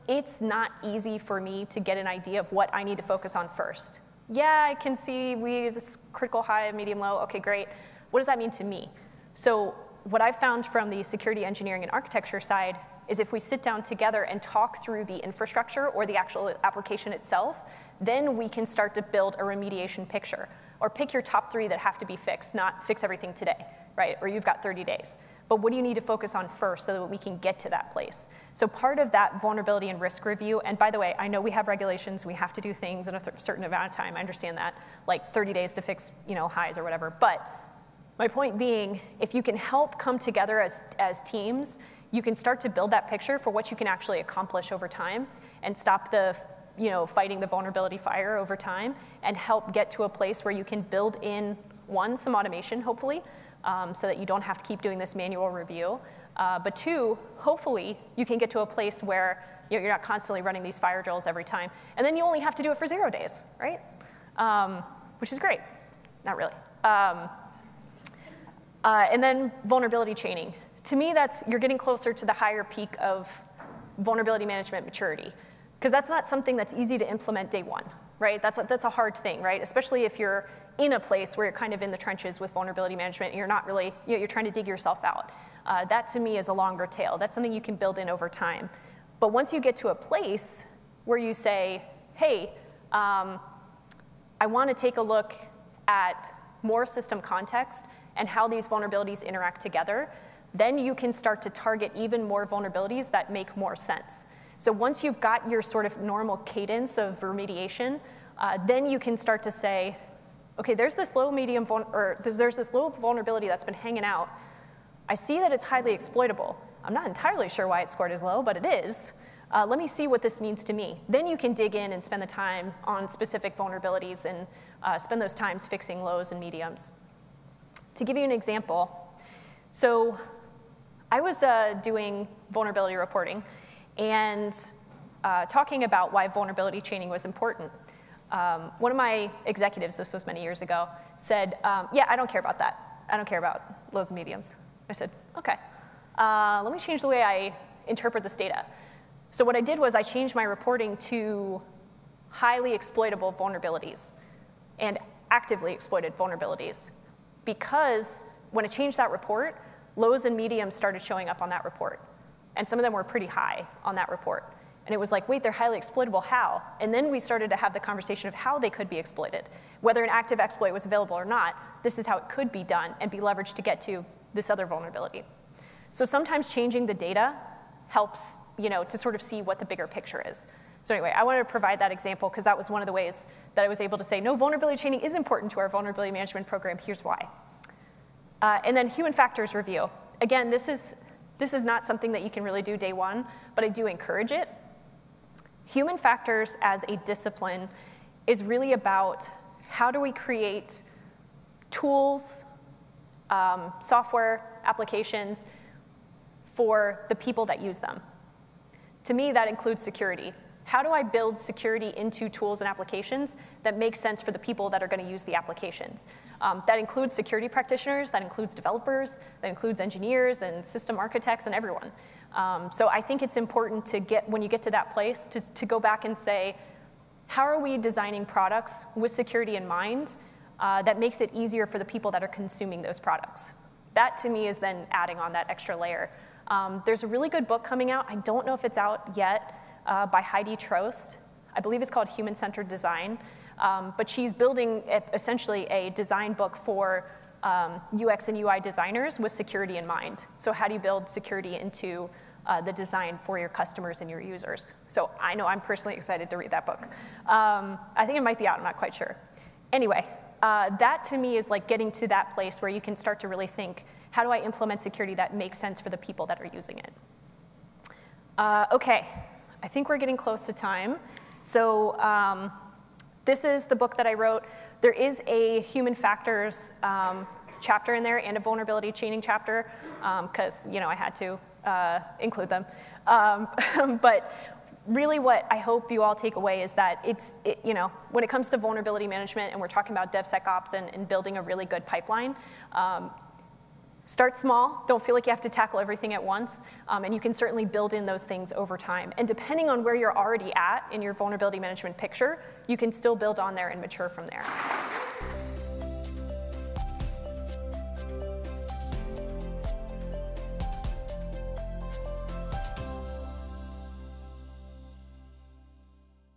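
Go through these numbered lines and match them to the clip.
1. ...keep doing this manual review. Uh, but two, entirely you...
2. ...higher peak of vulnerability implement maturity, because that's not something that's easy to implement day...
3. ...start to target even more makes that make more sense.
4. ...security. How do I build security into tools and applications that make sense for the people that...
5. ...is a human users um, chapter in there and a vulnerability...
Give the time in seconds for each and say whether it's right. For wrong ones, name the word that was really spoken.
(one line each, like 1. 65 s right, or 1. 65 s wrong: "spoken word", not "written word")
1. 54 s wrong: "hopefully", not "entirely"
2. 72 s wrong: "management", not "implement"
3. 101 s wrong: "vulnerabilities", not "makes"
4. 209 s right
5. 274 s wrong: "factors", not "users".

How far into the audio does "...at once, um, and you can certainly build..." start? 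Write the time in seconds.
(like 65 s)
296 s.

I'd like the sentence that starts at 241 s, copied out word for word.
I believe it's called Human Centered Design.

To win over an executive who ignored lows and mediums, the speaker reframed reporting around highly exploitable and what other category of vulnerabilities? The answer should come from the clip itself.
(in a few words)
Actively exploited vulnerabilities.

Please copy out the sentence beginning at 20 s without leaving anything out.
Or pick your top three that have to be fixed, not fix everything today, right?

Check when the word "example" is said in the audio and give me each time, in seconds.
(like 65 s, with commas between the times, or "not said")
128 s, 181 s.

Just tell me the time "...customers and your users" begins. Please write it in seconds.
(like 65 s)
253 s.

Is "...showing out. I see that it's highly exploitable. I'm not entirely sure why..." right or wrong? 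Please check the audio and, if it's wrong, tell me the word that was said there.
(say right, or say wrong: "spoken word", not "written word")
wrong: "hanging", not "showing".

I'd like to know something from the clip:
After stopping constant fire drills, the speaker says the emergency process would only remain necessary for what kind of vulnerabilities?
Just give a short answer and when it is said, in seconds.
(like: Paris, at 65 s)
Zero days, at 62 s.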